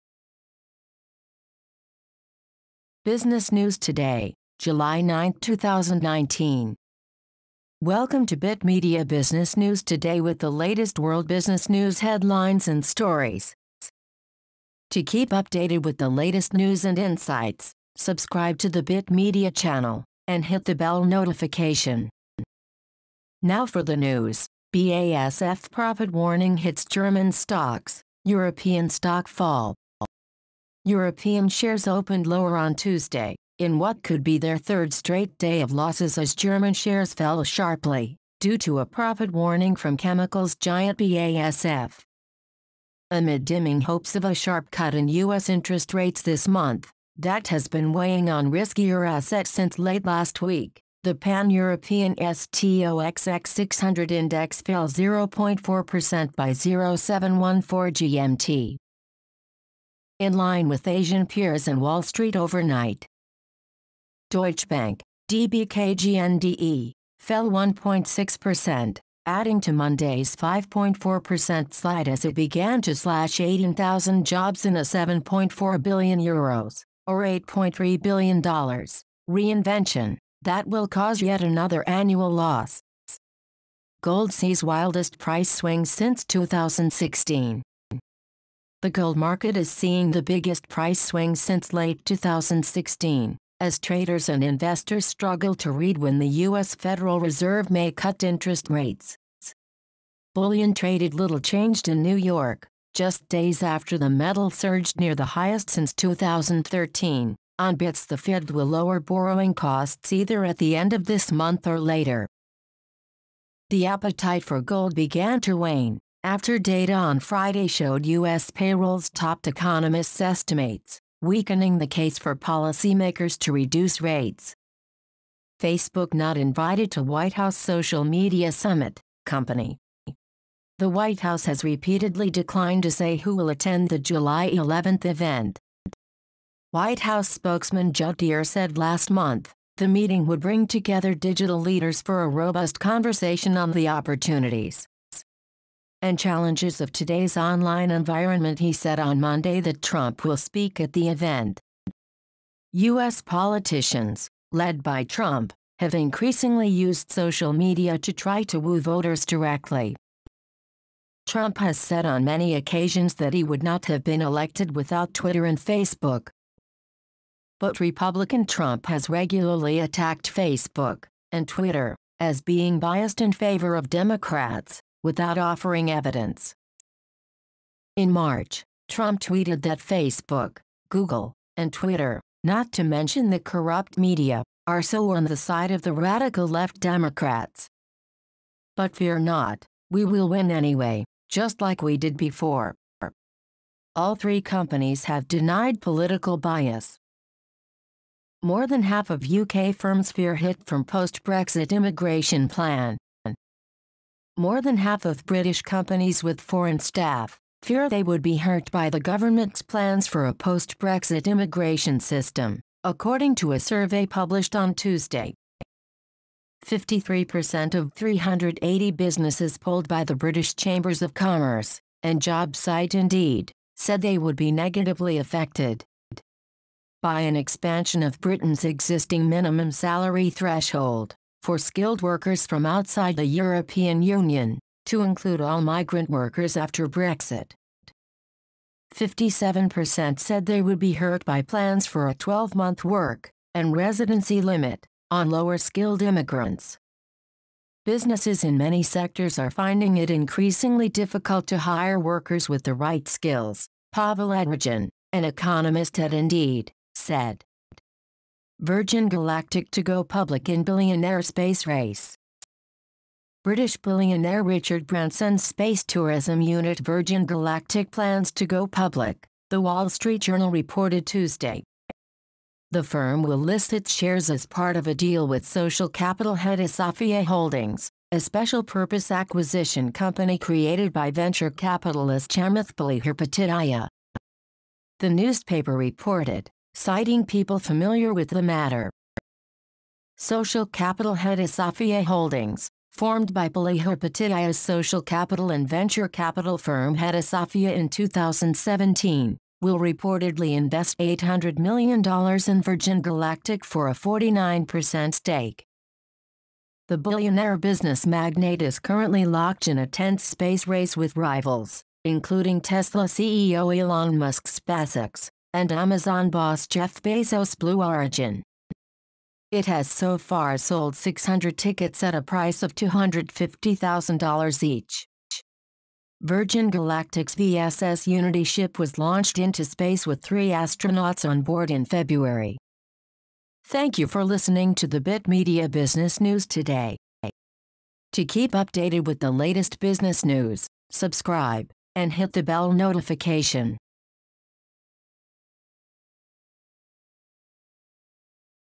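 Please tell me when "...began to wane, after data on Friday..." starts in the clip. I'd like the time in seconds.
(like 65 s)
114 s.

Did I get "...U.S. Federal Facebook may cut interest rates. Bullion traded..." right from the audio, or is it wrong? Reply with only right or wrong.
wrong.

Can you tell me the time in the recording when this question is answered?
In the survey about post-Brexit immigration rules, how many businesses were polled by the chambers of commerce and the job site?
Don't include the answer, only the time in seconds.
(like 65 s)
217 s.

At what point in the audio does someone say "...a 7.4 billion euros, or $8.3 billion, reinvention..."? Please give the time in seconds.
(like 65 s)
74 s.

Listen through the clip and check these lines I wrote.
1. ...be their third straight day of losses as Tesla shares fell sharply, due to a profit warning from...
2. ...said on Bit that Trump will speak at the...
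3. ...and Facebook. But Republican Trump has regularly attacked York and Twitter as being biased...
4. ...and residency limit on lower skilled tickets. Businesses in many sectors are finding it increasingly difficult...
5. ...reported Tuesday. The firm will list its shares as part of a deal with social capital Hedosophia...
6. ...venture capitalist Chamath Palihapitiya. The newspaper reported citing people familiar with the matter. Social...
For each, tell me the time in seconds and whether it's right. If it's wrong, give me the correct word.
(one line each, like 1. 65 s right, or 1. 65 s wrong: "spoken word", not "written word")
1. 34 s wrong: "German", not "Tesla"
2. 148 s wrong: "Monday", not "Bit"
3. 165 s wrong: "Facebook", not "York"
4. 243 s wrong: "immigrants", not "tickets"
5. 270 s right
6. 281 s right.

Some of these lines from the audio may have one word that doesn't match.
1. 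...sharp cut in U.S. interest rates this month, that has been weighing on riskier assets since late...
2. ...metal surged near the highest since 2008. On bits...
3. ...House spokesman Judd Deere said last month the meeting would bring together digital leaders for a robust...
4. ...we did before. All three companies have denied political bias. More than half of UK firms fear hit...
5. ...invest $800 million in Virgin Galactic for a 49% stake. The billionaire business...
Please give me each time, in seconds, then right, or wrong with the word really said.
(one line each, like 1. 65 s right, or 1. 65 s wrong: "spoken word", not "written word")
1. 44 s right
2. 104 s wrong: "2013", not "2008"
3. 137 s right
4. 191 s right
5. 300 s right.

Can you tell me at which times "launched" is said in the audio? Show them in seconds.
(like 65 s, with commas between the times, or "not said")
328 s.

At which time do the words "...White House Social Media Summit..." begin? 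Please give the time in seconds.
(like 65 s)
127 s.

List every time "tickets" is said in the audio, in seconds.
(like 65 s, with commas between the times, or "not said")
321 s.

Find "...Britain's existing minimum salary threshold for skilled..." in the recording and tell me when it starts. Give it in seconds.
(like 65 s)
228 s.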